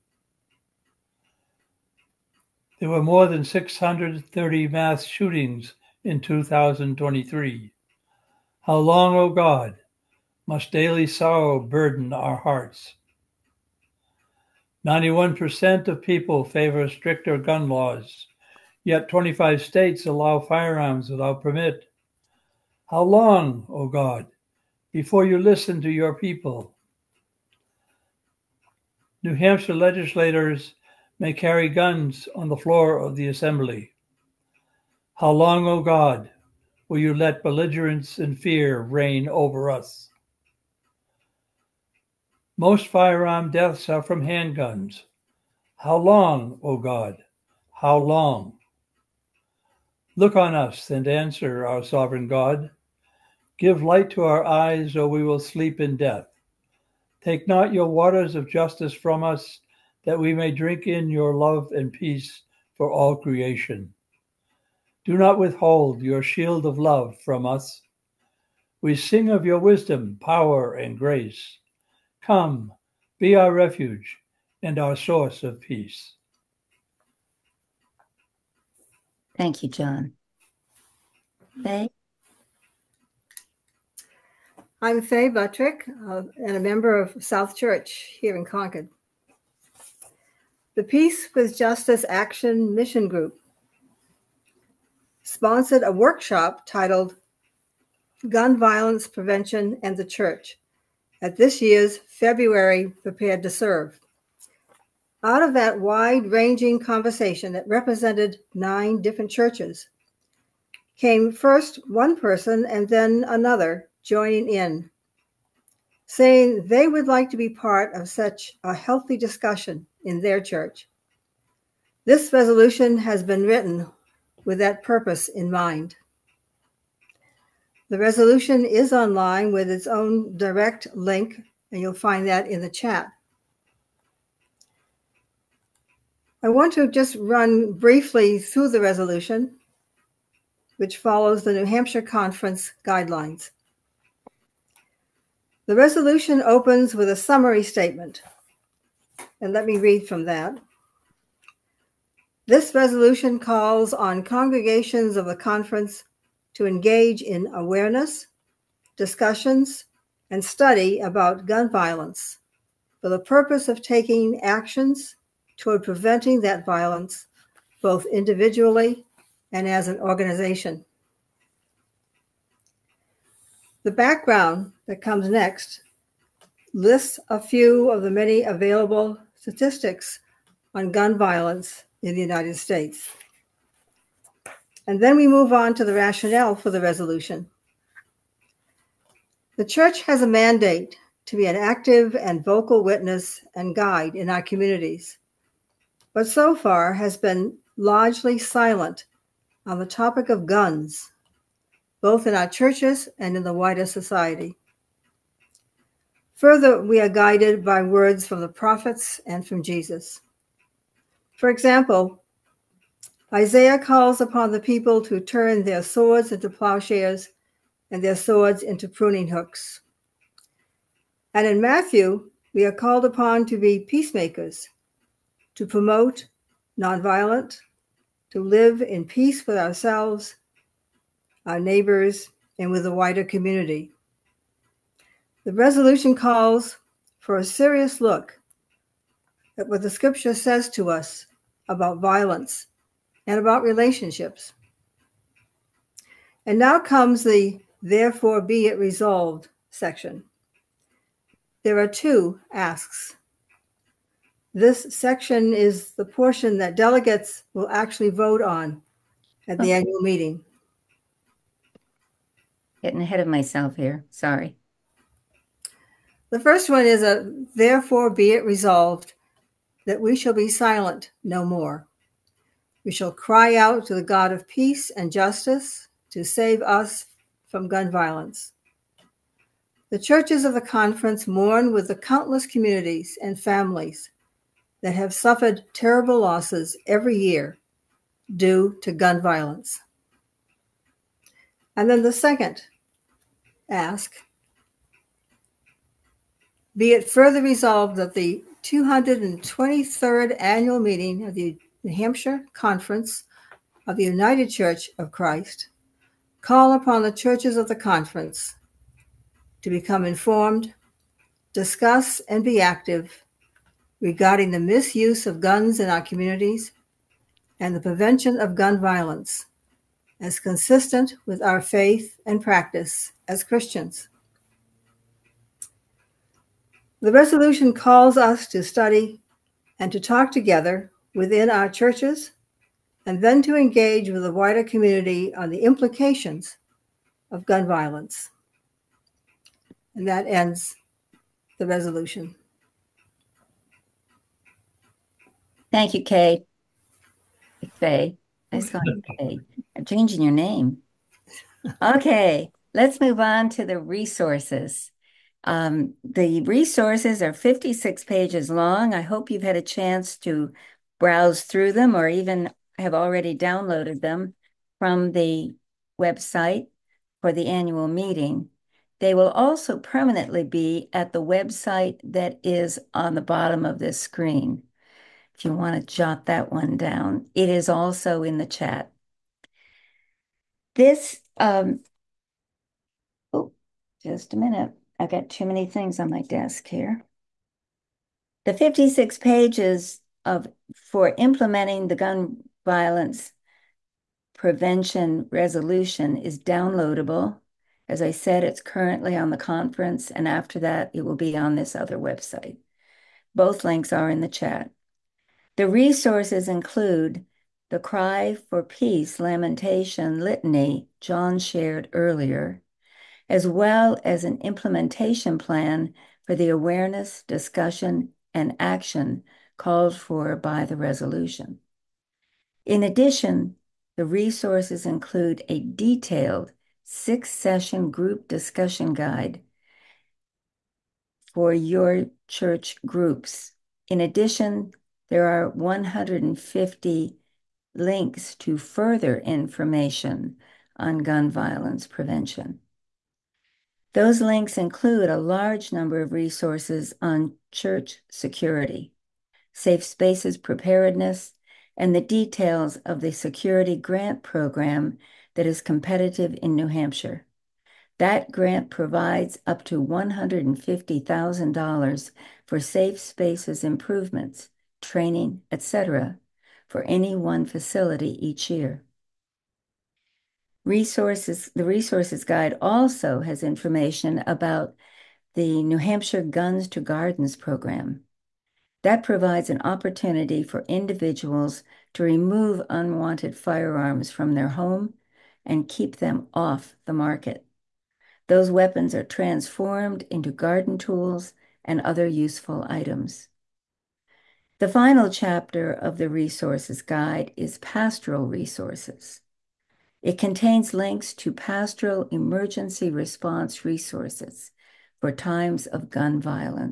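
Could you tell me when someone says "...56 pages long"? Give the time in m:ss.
5:57.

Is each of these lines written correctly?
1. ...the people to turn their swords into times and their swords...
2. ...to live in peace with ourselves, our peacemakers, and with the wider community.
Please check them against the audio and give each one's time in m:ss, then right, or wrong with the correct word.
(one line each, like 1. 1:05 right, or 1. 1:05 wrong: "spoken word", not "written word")
1. 3:34 wrong: "plowshares", not "times"
2. 3:48 wrong: "neighbors", not "peacemakers".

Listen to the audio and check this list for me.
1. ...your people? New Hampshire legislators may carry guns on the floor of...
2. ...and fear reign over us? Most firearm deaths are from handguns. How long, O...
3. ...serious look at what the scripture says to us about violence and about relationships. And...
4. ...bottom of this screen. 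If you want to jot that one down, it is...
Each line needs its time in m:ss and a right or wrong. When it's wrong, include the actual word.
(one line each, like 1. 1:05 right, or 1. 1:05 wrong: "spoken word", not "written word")
1. 0:25 right
2. 0:38 right
3. 3:57 right
4. 6:13 right.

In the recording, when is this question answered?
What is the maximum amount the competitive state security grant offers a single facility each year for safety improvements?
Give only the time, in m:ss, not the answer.
7:39.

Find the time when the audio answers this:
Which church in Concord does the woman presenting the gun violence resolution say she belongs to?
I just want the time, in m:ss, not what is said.
1:27.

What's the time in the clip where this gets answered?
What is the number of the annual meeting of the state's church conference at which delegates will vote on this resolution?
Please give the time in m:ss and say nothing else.
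4:58.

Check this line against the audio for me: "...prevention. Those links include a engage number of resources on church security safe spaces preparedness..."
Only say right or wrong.
wrong.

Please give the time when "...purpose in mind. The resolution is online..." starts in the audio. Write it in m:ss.
2:04.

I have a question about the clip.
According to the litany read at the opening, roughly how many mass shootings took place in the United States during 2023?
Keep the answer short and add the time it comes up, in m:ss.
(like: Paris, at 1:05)
more than 630, at 0:03.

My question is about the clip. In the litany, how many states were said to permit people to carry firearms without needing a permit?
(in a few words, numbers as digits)
25.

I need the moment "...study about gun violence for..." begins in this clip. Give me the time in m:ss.
2:40.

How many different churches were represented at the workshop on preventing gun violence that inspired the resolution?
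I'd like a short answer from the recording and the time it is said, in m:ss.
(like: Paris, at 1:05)
9, at 1:48.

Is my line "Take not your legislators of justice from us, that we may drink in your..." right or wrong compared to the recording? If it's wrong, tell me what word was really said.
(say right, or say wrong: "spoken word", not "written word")
wrong: "waters", not "legislators".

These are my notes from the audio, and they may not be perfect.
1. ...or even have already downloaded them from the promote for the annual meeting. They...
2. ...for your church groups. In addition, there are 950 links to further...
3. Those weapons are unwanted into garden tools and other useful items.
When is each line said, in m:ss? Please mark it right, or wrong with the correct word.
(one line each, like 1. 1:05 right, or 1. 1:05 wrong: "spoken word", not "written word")
1. 6:01 wrong: "website", not "promote"
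2. 7:11 wrong: "150", not "950"
3. 8:08 wrong: "transformed", not "unwanted".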